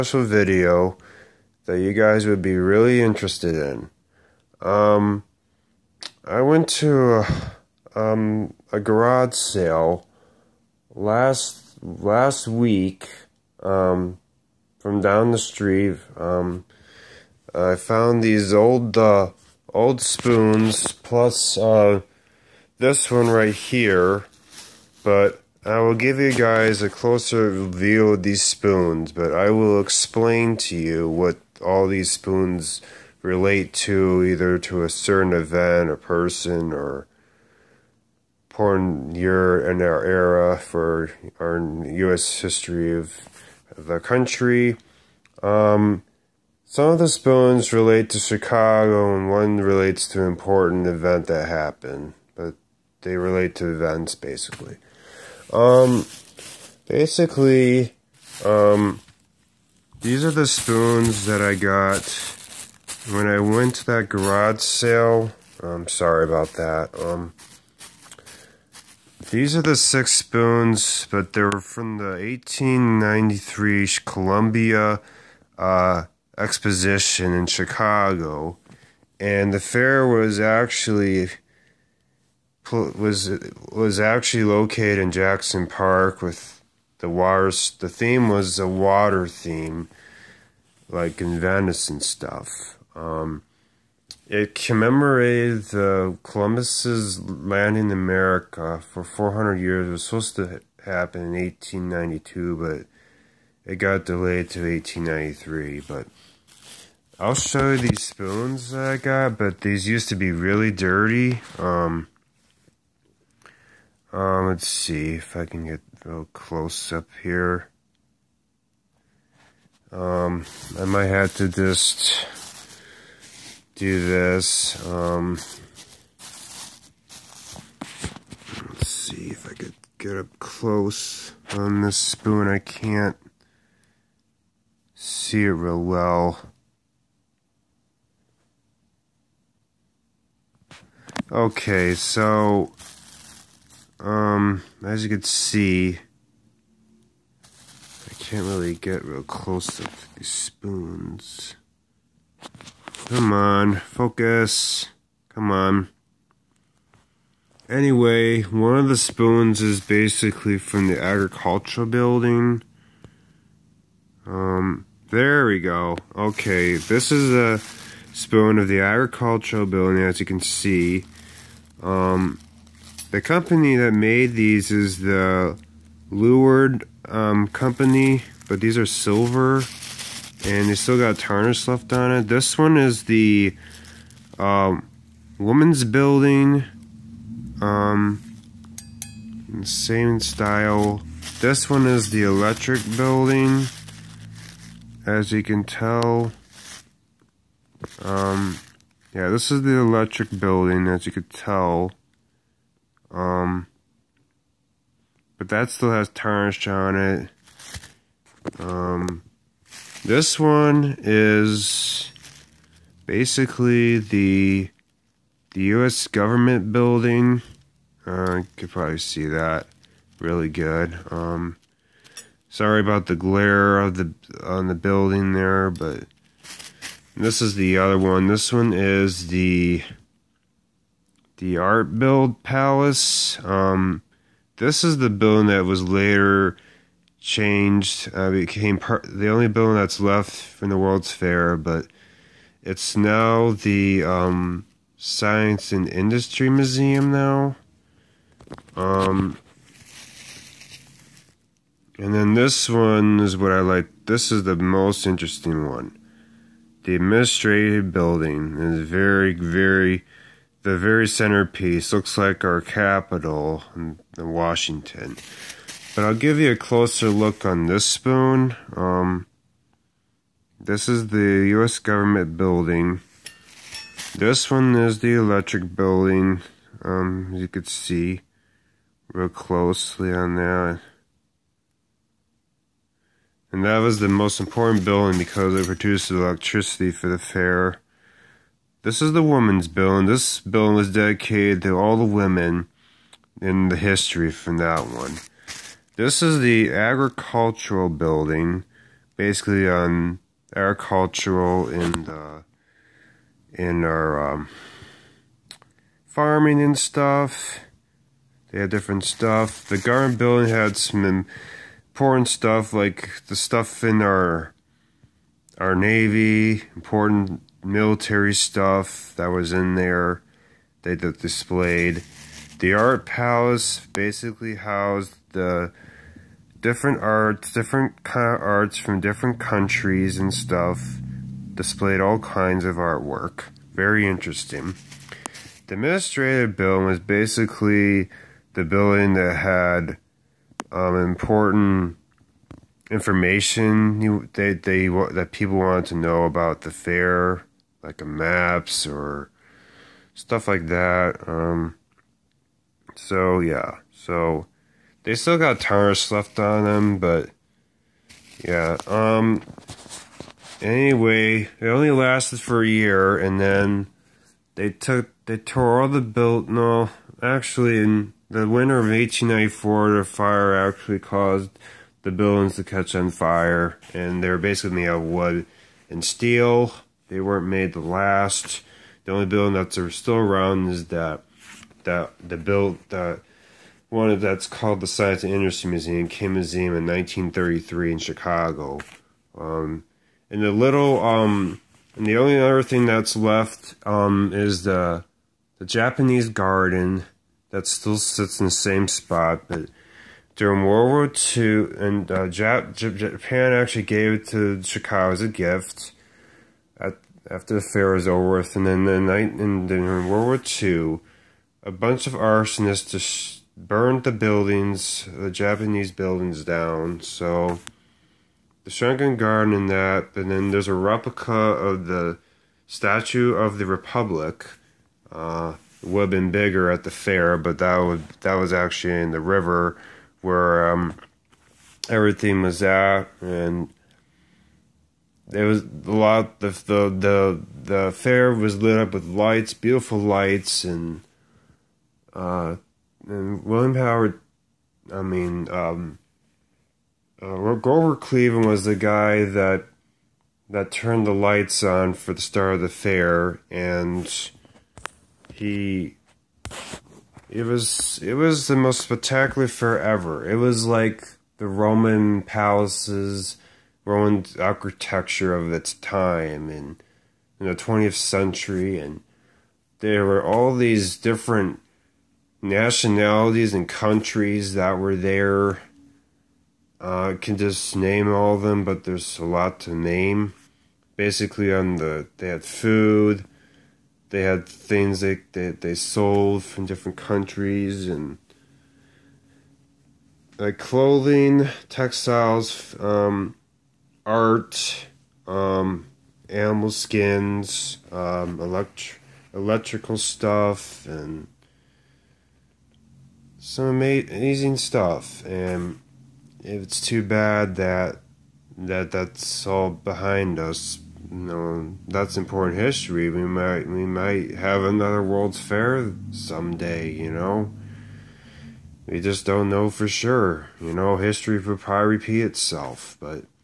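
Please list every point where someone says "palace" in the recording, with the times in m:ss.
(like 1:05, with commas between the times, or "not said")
3:52, 5:23, 7:42.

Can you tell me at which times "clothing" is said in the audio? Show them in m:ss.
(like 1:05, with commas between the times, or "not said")
8:10.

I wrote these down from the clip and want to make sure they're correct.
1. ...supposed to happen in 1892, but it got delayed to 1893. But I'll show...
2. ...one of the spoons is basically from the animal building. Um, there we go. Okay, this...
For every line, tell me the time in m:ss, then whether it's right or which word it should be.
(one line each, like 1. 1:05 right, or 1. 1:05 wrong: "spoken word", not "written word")
1. 1:40 right
2. 2:38 wrong: "agricultural", not "animal".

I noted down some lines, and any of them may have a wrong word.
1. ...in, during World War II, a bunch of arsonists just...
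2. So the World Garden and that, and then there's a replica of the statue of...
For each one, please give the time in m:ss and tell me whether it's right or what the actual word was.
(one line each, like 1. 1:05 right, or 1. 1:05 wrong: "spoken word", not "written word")
1. 6:49 right
2. 6:57 wrong: "Shrunken", not "World".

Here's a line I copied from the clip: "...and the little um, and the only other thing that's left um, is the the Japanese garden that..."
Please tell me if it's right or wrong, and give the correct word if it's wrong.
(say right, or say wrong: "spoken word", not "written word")
right.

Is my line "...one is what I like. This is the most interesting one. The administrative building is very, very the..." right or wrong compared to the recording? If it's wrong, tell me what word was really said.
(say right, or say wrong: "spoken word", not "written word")
right.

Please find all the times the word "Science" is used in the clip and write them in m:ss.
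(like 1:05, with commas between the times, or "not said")
4:04, 6:24.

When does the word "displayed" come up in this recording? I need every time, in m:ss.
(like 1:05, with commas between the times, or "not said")
5:20, 5:31.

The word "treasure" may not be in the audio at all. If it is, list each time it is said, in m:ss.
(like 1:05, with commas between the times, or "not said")
not said.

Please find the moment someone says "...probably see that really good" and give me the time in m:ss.
3:38.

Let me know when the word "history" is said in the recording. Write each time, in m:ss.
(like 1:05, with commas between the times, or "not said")
0:42, 4:53, 8:32, 8:40.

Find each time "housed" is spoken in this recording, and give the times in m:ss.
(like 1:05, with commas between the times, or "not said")
5:24.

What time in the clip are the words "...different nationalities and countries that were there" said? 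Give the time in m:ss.
7:50.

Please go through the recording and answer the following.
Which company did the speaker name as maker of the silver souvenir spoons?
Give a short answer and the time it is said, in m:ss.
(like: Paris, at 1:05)
Lured, at 2:56.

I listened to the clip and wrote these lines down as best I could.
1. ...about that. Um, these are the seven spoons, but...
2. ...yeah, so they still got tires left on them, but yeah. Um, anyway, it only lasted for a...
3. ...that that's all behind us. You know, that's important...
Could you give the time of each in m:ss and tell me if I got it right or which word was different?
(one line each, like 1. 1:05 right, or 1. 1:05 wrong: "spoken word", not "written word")
1. 1:06 wrong: "six", not "seven"
2. 5:53 right
3. 8:28 right.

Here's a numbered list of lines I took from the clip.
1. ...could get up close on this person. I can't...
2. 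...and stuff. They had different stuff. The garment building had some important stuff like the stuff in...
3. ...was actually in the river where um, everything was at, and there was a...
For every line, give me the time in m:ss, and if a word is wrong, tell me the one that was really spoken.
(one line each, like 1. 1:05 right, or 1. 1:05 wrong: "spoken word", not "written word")
1. 2:09 wrong: "spoon", not "person"
2. 5:06 right
3. 7:08 right.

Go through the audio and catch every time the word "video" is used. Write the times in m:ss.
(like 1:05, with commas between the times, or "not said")
0:00.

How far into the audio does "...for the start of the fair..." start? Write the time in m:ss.
7:31.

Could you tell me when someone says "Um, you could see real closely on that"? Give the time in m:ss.
4:36.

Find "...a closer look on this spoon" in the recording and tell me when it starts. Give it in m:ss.
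4:26.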